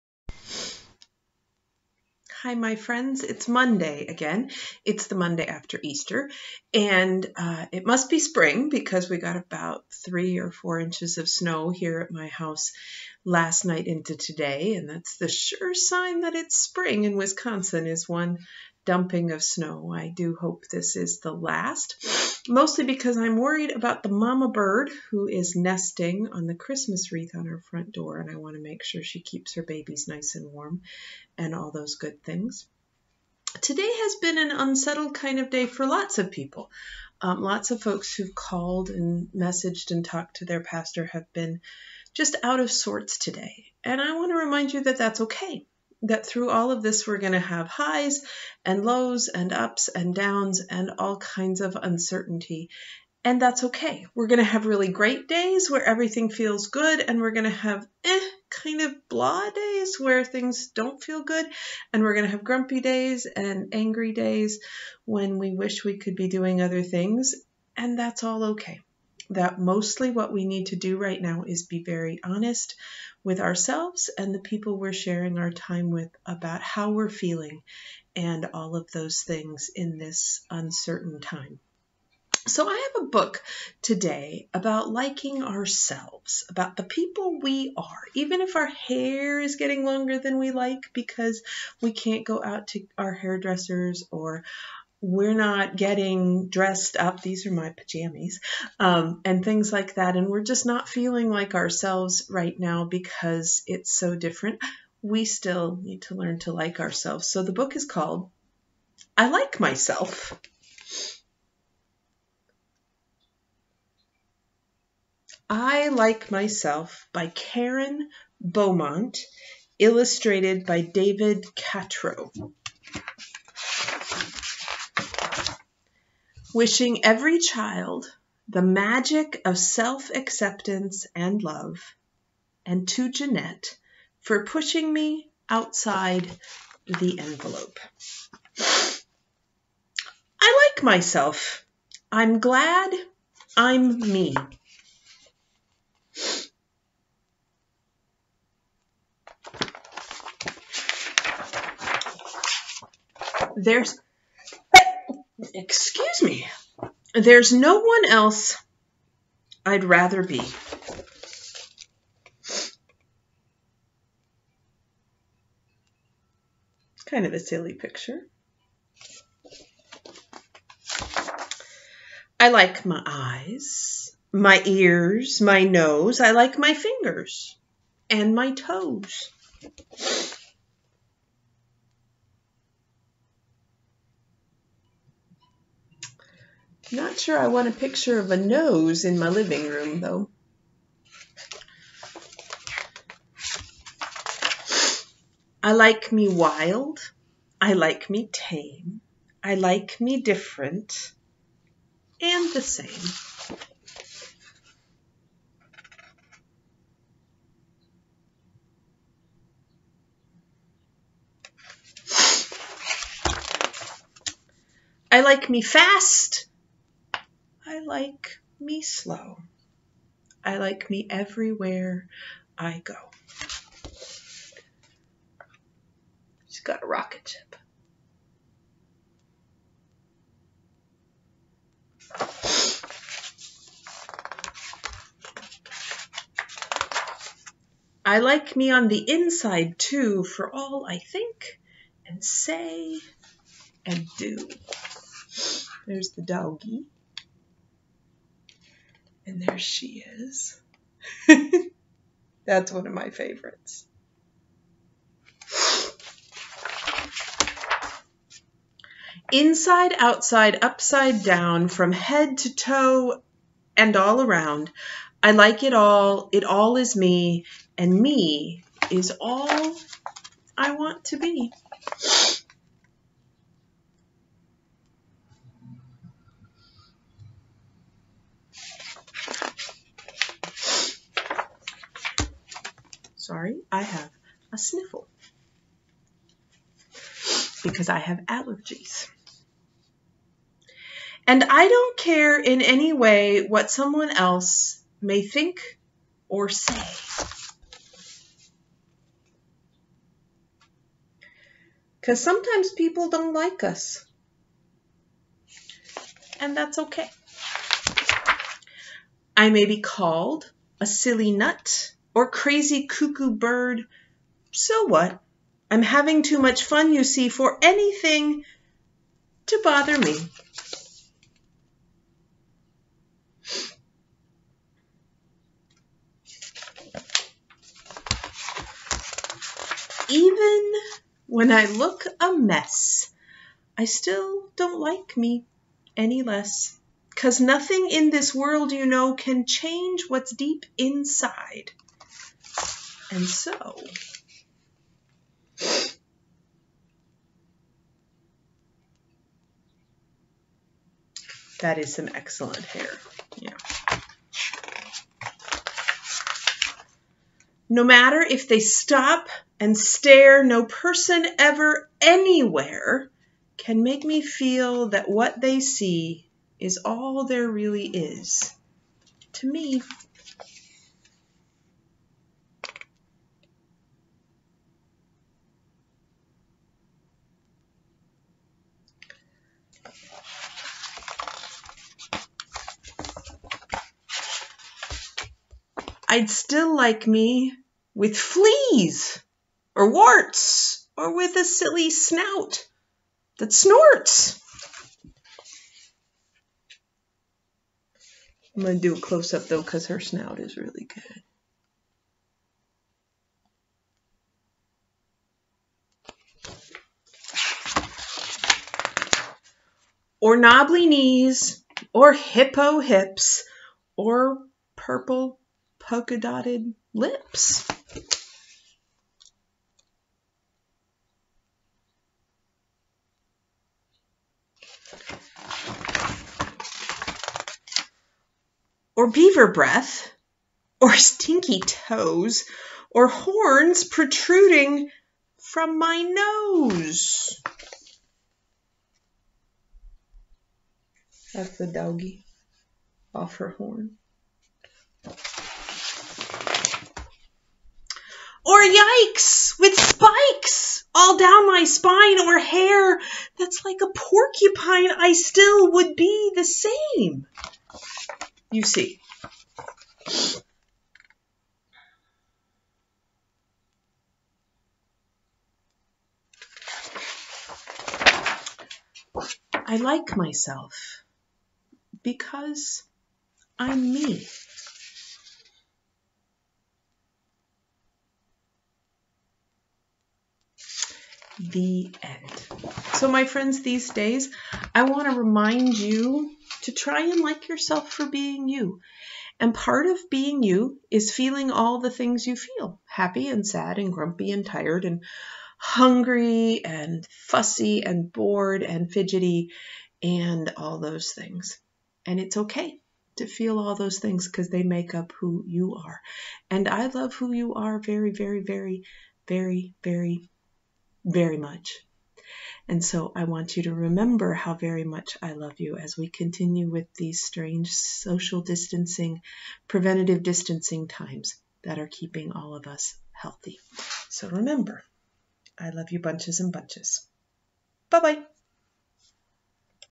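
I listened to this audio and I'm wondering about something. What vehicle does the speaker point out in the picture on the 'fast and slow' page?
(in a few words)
Rocket ship.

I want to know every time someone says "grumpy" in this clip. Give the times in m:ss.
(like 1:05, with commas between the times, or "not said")
1:02, 8:13.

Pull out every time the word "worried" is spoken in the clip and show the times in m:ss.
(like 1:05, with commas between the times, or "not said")
0:23.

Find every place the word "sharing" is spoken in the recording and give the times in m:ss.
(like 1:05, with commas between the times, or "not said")
1:14.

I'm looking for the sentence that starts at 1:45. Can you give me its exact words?
We still need to learn to like ourselves.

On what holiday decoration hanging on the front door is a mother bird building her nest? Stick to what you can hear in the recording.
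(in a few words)
Christmas wreath.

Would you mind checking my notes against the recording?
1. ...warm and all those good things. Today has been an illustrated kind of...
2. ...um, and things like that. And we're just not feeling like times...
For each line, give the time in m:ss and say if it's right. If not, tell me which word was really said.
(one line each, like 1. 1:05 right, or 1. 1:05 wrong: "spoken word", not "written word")
1. 0:30 wrong: "unsettled", not "illustrated"
2. 1:38 wrong: "ourselves", not "times".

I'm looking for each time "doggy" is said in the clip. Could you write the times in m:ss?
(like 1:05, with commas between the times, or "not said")
4:06, 7:21.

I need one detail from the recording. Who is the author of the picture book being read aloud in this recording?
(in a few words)
Karen Beaumont.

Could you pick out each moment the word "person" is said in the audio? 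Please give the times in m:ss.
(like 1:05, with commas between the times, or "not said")
6:00.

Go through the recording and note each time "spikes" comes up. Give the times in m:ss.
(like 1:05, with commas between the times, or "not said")
7:29.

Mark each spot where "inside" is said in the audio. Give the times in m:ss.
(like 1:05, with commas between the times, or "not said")
3:59, 4:19, 5:40.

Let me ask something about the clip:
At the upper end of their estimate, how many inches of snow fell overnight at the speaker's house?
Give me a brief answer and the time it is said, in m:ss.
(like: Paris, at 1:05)
4, at 0:10.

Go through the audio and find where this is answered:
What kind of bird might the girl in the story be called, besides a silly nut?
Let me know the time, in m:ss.
5:12.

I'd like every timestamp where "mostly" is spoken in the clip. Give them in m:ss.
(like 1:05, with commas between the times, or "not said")
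0:22, 1:09.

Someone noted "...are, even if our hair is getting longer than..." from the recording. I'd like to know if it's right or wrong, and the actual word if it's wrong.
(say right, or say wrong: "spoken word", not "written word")
right.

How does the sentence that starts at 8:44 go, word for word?
So remember, I love you bunches and bunches.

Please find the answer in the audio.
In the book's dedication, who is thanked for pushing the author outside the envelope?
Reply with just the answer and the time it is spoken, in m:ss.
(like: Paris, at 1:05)
Jeanette, at 2:13.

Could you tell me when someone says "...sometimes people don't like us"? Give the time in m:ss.
5:02.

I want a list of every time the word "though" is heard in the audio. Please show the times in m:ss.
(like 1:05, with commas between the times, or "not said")
3:10, 6:39.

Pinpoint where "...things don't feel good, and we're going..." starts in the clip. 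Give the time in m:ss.
1:00.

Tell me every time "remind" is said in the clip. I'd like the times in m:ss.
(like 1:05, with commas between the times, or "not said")
0:44, 8:05.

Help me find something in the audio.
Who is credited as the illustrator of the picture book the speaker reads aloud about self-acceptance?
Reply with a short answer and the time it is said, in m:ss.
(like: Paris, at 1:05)
David Catrow, at 2:00.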